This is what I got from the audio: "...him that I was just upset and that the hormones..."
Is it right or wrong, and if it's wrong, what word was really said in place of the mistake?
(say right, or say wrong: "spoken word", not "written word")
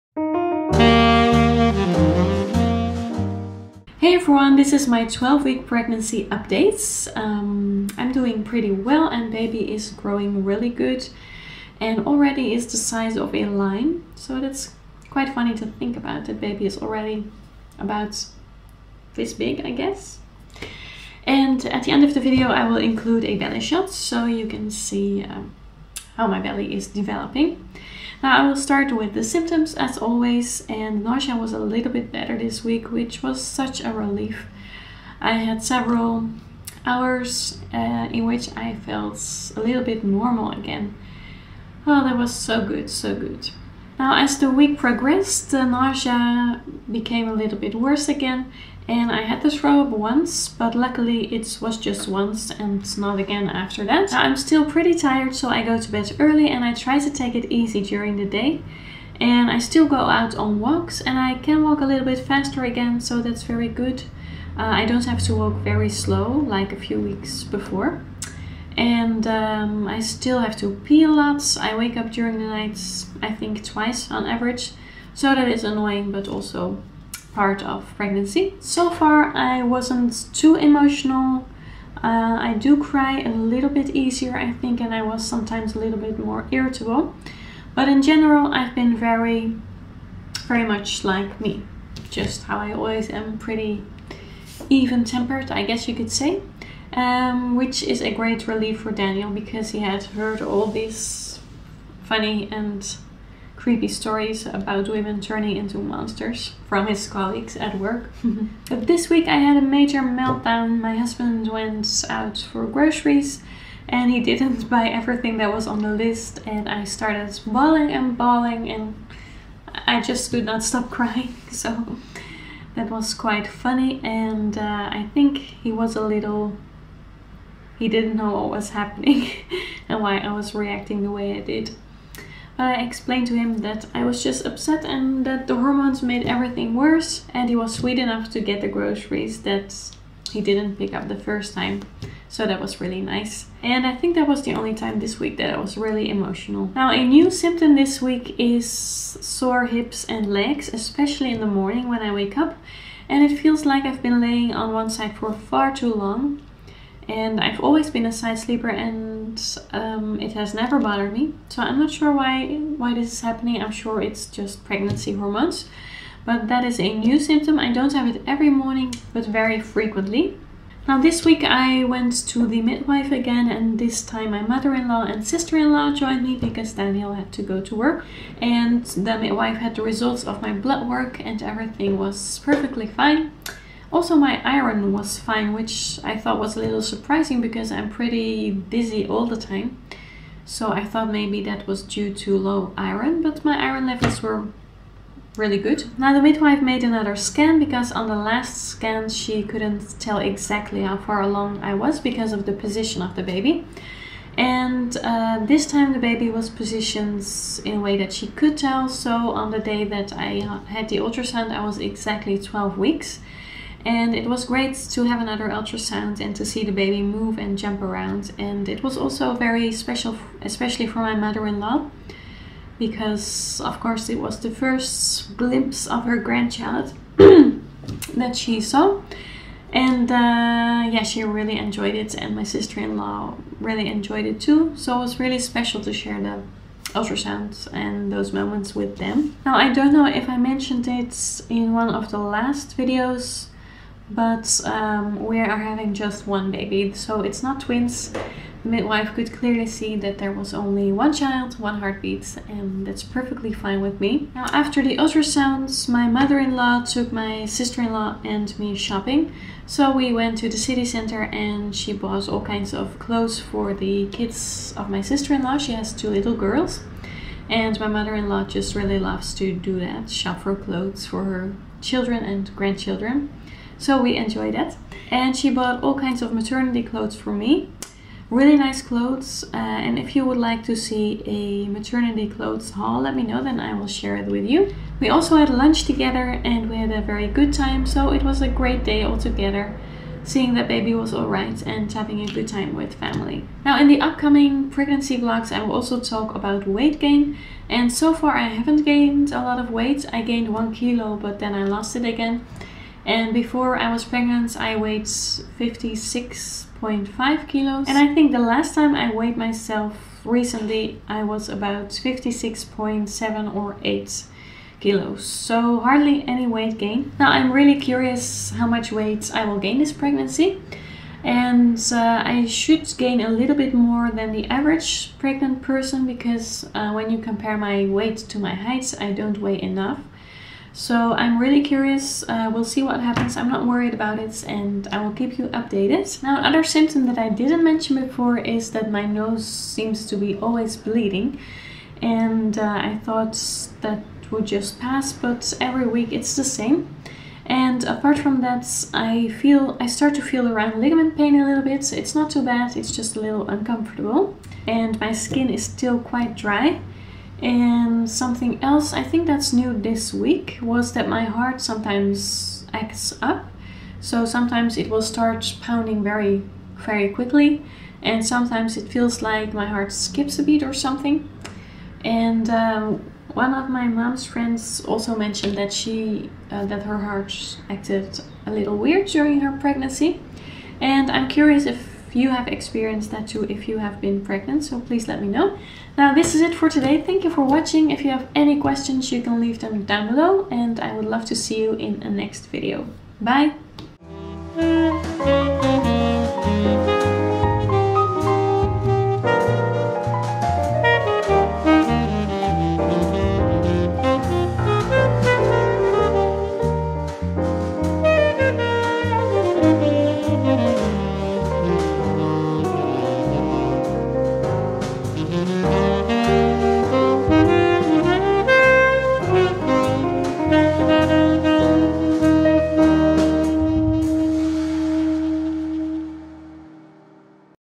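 right.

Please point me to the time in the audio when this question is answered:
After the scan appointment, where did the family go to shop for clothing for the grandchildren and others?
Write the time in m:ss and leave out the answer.
4:20.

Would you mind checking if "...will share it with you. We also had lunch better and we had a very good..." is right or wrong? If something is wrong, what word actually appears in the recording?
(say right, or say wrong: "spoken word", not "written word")
wrong: "together", not "better".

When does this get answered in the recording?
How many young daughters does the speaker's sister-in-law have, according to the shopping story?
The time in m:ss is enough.
4:25.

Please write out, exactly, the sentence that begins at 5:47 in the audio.
And apart from that, I feel I start to feel around ligament pain a little bit.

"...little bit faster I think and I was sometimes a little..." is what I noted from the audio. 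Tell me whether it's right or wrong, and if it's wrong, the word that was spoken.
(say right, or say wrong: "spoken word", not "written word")
wrong: "easier", not "faster".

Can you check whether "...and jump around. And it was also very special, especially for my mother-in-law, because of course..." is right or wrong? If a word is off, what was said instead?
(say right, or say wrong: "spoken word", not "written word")
right.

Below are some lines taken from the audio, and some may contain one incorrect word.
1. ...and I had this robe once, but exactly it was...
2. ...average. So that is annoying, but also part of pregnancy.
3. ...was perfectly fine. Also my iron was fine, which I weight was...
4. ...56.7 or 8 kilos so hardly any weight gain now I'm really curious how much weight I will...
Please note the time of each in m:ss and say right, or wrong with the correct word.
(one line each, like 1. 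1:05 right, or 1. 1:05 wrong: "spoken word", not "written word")
1. 0:48 wrong: "luckily", not "exactly"
2. 1:14 right
3. 3:01 wrong: "thought", not "weight"
4. 5:11 right.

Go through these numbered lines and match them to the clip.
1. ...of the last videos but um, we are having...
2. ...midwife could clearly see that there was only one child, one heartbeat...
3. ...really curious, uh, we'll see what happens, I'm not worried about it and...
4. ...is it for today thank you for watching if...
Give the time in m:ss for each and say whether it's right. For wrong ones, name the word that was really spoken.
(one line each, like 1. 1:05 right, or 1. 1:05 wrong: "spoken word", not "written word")
1. 4:01 right
2. 4:08 right
3. 5:31 right
4. 6:26 right.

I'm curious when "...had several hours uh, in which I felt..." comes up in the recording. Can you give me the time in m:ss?
0:35.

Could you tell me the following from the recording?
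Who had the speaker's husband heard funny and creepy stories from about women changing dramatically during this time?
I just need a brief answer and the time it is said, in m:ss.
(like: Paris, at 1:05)
His colleagues, at 1:47.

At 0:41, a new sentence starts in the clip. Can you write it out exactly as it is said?
Oh, that was so good, so good.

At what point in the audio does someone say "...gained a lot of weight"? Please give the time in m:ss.
4:58.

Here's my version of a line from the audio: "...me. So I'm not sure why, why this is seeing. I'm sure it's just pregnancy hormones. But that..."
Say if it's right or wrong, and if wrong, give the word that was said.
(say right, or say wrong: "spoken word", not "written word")
wrong: "happening", not "seeing".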